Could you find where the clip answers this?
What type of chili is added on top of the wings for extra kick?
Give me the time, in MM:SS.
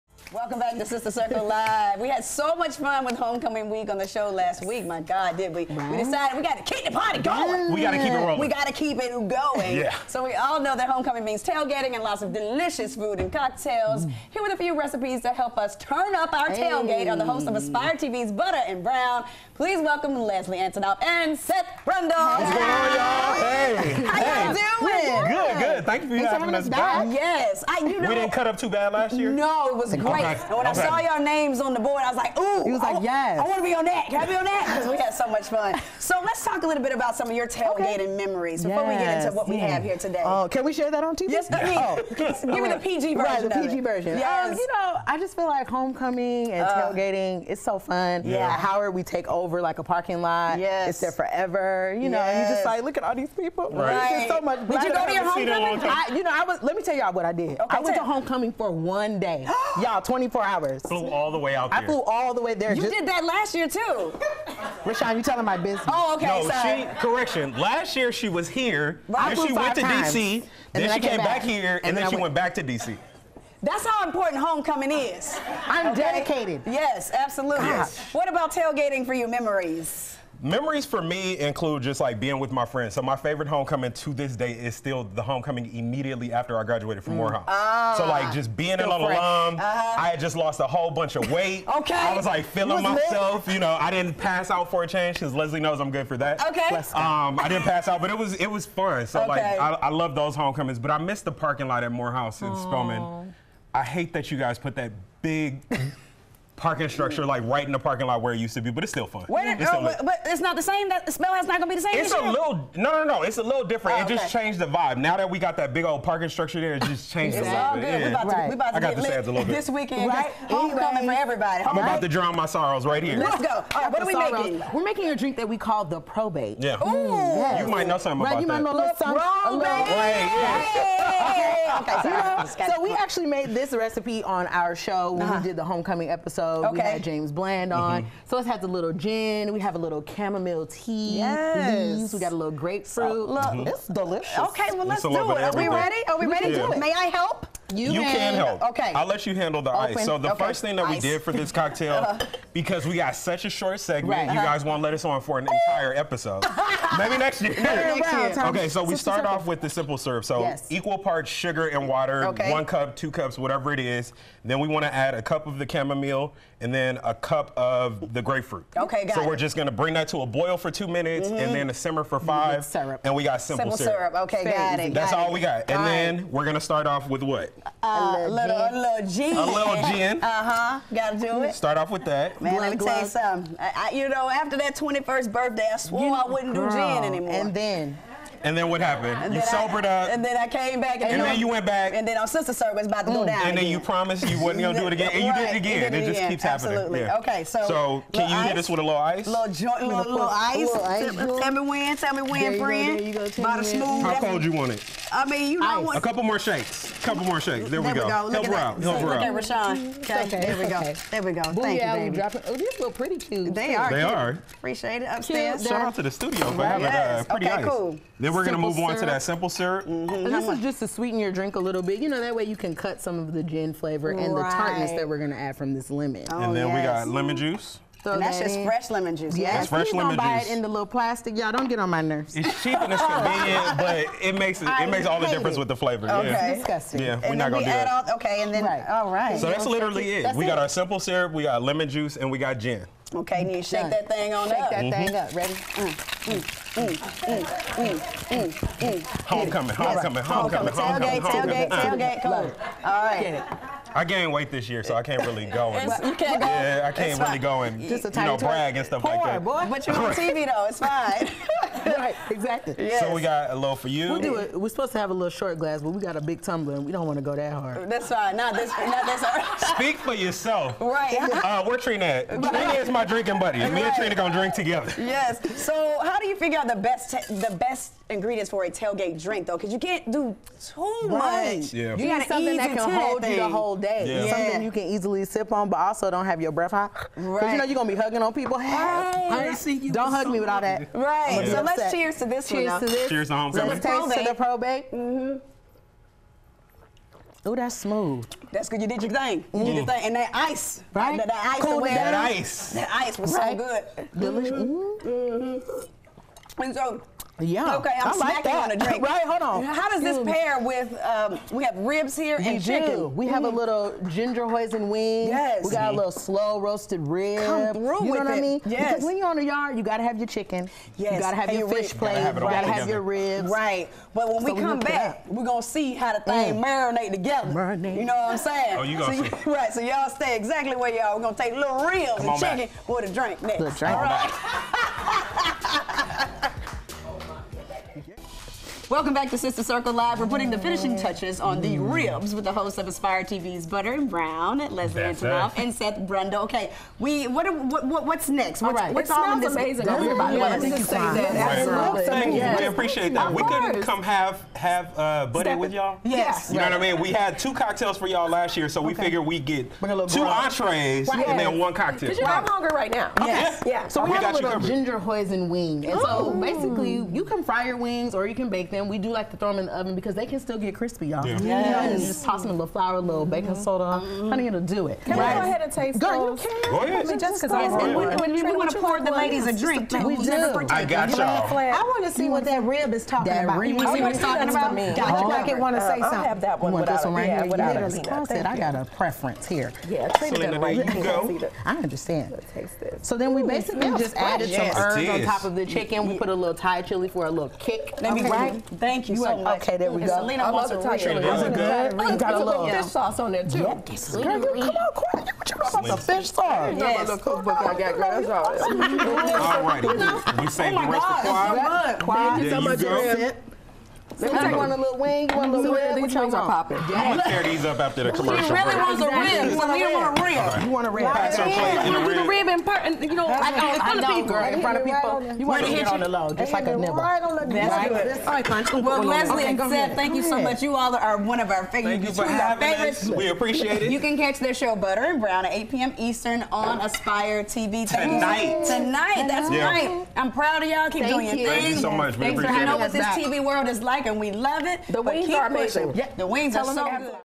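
06:36.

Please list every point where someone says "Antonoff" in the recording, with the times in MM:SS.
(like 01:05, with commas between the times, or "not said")
00:20, 05:45.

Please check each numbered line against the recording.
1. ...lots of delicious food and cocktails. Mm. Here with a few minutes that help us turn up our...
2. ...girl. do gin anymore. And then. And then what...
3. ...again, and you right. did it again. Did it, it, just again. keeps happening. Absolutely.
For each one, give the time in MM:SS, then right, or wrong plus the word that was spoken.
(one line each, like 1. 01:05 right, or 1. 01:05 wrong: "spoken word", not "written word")
1. 00:12 wrong: "recipes", not "minutes"
2. 03:06 right
3. 03:14 right.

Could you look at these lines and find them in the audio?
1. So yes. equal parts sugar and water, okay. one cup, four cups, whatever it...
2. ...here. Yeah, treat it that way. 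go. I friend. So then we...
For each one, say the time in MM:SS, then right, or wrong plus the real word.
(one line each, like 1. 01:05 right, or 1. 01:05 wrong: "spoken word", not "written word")
1. 02:40 wrong: "two", not "four"
2. 06:29 wrong: "understand", not "friend".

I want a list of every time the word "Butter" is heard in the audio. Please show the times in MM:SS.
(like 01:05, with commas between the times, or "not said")
00:18, 05:43, 07:14.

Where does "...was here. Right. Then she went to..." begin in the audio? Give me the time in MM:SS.
01:08.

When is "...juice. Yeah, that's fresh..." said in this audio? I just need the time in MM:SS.
03:49.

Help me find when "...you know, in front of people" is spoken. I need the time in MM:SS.
07:03.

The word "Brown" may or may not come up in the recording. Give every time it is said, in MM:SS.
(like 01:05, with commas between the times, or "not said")
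00:18, 05:44, 07:15.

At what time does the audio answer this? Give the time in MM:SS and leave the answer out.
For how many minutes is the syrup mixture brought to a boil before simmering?
02:50.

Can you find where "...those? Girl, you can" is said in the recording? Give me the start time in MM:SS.
06:16.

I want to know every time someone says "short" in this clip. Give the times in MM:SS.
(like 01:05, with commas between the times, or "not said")
02:33, 04:25.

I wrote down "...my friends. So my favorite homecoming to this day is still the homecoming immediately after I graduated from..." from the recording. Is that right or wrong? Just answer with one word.
right.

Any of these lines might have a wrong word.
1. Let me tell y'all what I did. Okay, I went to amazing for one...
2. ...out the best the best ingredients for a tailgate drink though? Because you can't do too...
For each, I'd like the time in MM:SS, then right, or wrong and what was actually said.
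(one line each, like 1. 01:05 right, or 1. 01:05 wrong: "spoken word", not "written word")
1. 00:56 wrong: "homecoming", not "amazing"
2. 04:36 right.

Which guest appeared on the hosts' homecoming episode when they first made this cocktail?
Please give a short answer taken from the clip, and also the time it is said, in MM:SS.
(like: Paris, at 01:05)
James Bland, at 02:17.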